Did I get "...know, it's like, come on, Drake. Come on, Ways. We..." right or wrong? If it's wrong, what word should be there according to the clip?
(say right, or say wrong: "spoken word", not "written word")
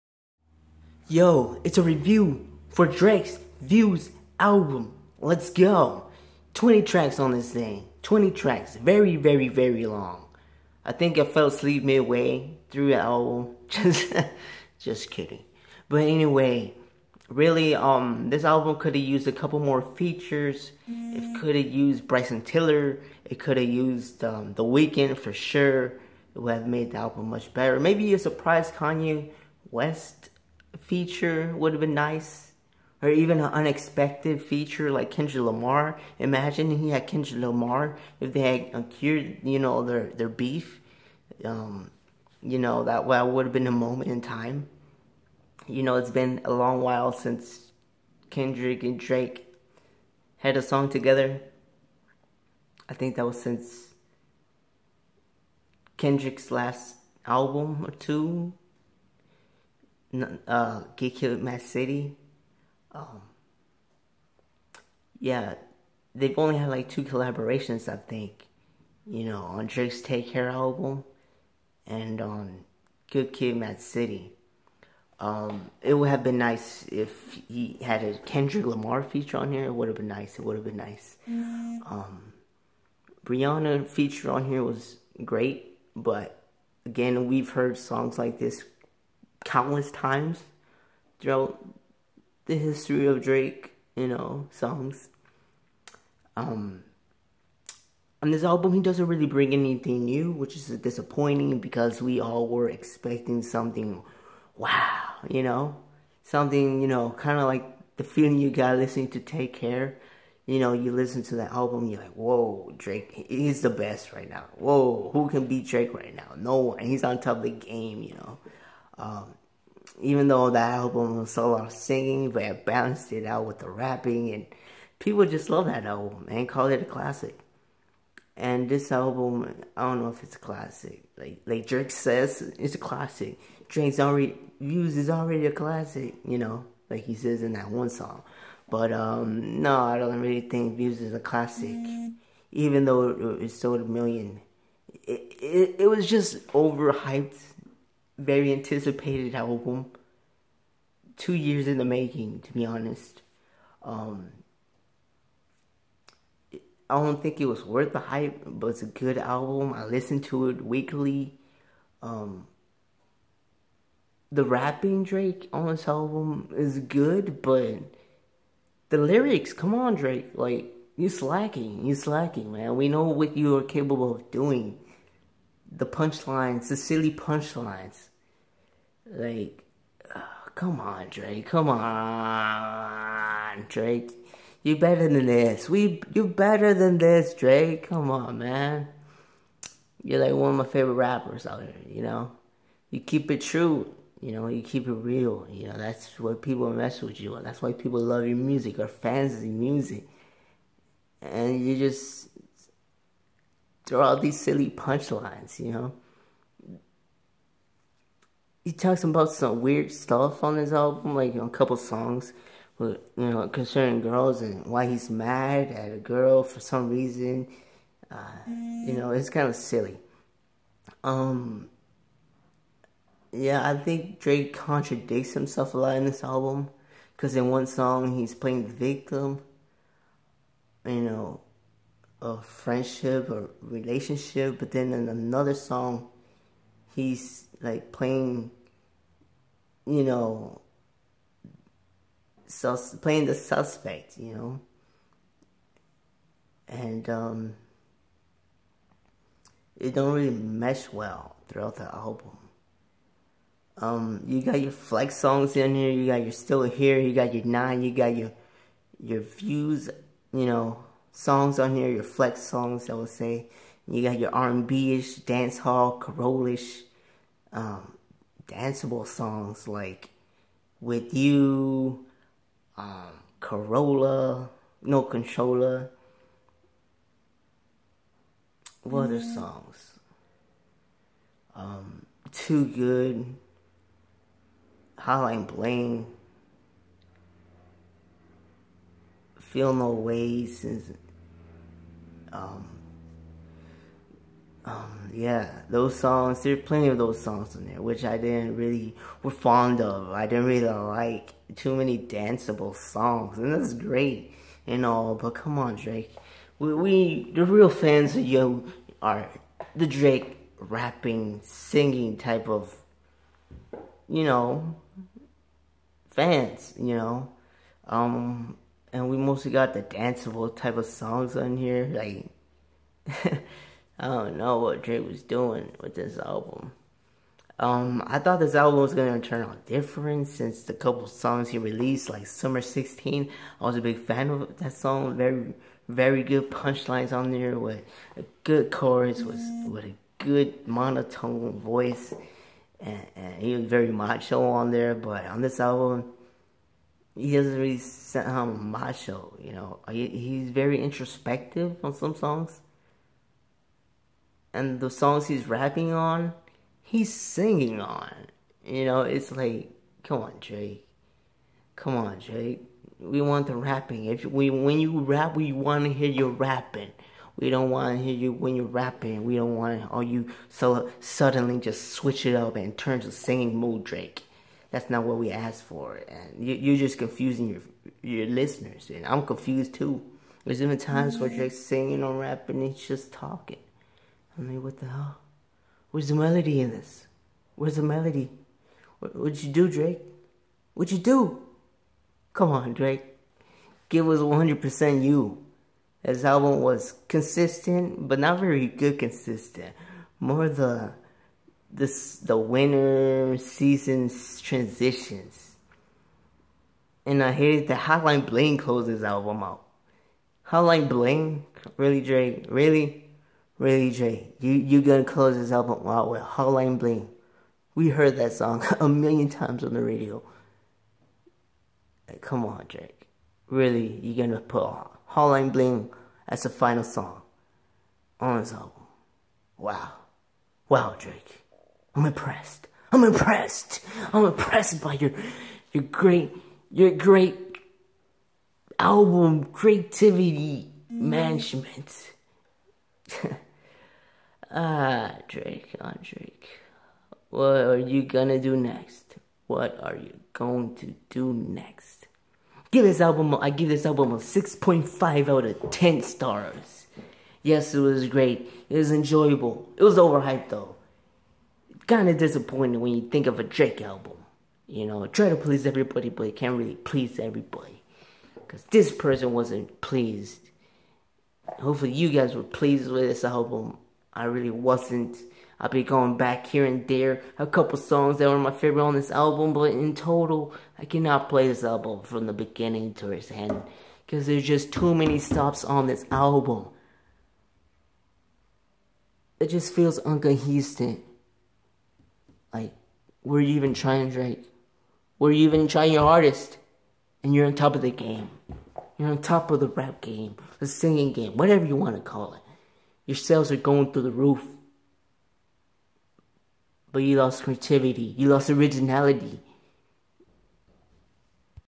wrong: "Drake", not "Ways".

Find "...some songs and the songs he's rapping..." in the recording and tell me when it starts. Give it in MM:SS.
05:51.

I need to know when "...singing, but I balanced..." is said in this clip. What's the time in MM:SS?
02:01.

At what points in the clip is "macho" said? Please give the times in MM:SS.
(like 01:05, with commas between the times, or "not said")
05:43, 05:48.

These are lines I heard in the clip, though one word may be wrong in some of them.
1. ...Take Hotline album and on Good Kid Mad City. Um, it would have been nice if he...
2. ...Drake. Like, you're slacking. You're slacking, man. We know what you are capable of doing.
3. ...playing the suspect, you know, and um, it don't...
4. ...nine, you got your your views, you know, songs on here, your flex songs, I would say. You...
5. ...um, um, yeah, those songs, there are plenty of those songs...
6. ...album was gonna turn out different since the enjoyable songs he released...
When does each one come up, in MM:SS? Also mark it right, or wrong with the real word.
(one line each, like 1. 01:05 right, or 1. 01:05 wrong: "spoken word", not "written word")
1. 01:10 wrong: "Care", not "Hotline"
2. 02:49 right
3. 04:02 right
4. 04:17 right
5. 04:52 right
6. 05:28 wrong: "couple", not "enjoyable".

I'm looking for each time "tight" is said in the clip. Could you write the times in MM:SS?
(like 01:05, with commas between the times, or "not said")
not said.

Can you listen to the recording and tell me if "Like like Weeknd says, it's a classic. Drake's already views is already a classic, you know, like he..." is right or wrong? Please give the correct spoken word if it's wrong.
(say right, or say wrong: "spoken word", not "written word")
wrong: "Drake", not "Weeknd".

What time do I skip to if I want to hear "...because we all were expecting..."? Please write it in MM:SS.
01:41.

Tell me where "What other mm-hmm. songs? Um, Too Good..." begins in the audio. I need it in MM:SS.
04:38.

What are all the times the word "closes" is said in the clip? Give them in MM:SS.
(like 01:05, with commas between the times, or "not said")
06:48, 06:55.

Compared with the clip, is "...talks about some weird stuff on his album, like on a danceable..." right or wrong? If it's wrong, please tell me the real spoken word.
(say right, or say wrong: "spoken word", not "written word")
wrong: "couple", not "danceable".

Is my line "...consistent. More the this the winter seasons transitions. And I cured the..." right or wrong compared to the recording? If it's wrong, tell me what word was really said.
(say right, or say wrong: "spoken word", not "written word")
wrong: "hated", not "cured".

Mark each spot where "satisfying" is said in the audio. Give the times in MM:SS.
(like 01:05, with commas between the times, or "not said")
not said.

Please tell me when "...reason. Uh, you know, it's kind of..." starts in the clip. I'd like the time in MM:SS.
03:36.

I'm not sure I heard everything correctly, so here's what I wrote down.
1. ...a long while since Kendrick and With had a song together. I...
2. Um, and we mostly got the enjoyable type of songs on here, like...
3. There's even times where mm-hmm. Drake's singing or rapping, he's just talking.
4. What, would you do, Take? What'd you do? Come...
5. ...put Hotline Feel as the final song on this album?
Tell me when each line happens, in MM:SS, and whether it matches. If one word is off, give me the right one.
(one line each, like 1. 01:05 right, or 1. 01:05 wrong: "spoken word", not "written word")
1. 00:46 wrong: "Drake", not "With"
2. 05:17 wrong: "danceable", not "enjoyable"
3. 06:20 right
4. 06:28 wrong: "Drake", not "Take"
5. 07:04 wrong: "Bling", not "Feel".